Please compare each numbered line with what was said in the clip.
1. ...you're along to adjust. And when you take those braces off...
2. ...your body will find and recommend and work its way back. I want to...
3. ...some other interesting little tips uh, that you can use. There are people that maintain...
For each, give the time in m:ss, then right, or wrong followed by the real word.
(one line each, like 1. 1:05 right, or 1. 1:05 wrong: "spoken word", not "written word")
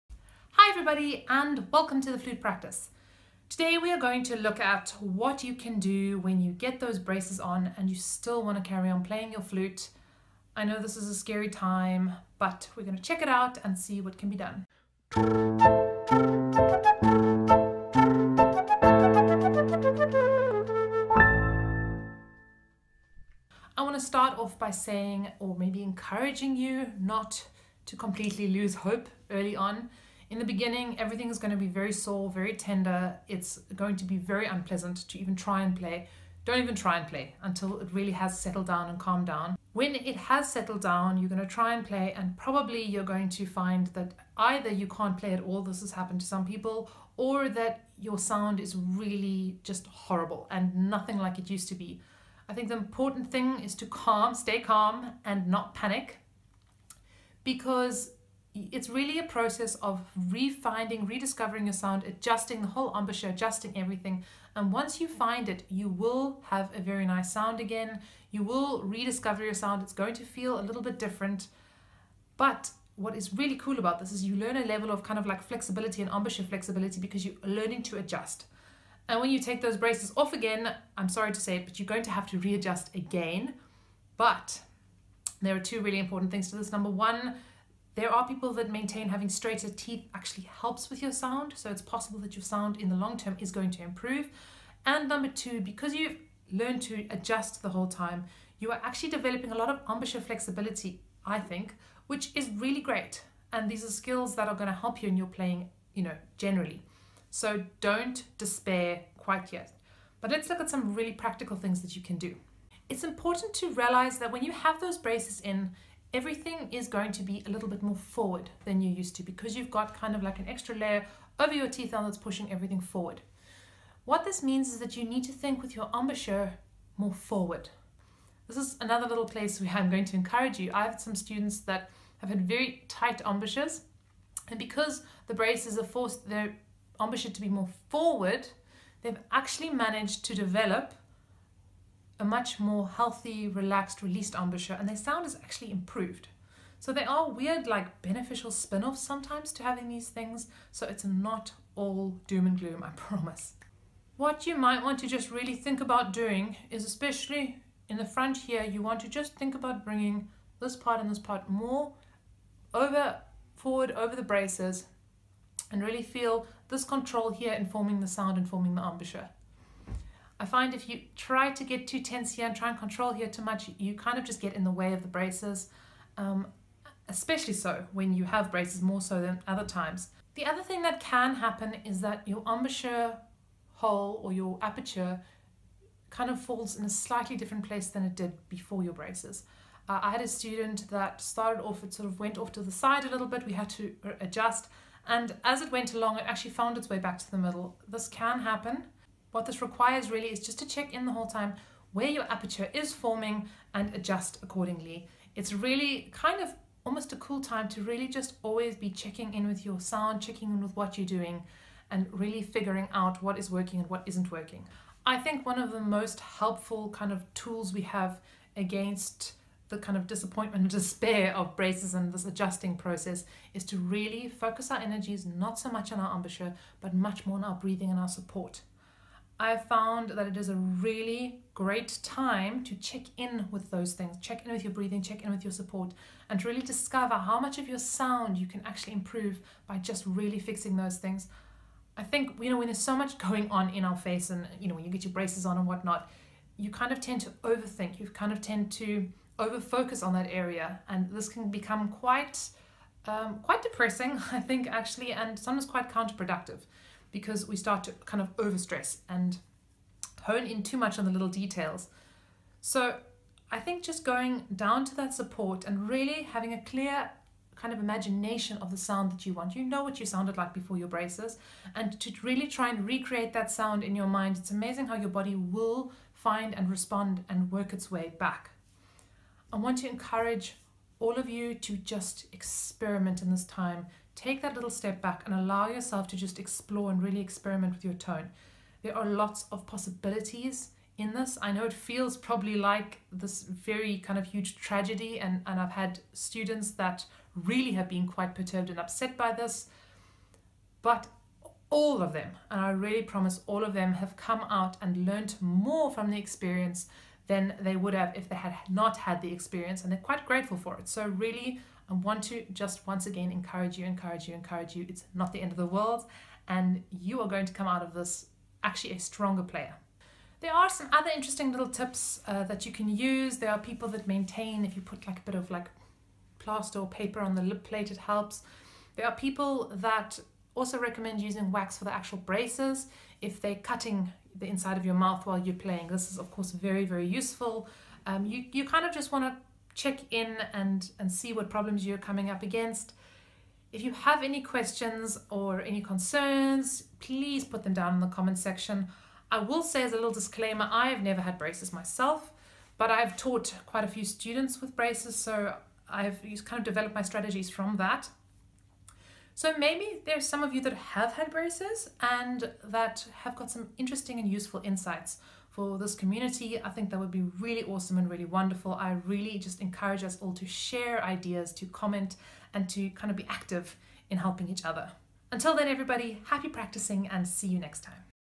1. 1:17 wrong: "learning", not "along"
2. 4:34 wrong: "respond", not "recommend"
3. 5:20 right.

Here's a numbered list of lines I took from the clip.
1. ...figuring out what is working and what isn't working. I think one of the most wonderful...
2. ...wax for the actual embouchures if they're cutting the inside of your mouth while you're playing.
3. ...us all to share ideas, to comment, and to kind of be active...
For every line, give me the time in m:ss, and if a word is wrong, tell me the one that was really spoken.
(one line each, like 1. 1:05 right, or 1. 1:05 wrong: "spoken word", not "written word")
1. 3:32 wrong: "helpful", not "wonderful"
2. 5:31 wrong: "braces", not "embouchures"
3. 6:10 right.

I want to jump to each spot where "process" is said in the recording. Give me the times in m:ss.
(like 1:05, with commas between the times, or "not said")
0:59, 3:42.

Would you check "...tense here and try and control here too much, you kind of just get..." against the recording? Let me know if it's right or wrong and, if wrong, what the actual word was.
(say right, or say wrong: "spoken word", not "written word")
right.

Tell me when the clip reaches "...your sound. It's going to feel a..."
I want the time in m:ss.
1:09.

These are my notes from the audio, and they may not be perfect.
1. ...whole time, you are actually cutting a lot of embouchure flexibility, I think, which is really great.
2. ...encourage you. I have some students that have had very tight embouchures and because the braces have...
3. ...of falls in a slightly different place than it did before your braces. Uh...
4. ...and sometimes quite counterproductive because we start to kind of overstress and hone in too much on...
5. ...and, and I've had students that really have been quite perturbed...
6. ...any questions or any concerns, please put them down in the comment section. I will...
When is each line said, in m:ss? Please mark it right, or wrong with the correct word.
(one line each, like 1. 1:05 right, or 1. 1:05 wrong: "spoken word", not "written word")
1. 1:37 wrong: "developing", not "cutting"
2. 2:10 right
3. 3:06 right
4. 4:15 right
5. 4:55 right
6. 5:44 right.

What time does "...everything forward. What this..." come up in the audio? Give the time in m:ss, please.
2:02.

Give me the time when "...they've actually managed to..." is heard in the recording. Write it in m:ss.
2:19.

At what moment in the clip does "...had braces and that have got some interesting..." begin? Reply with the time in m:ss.
6:01.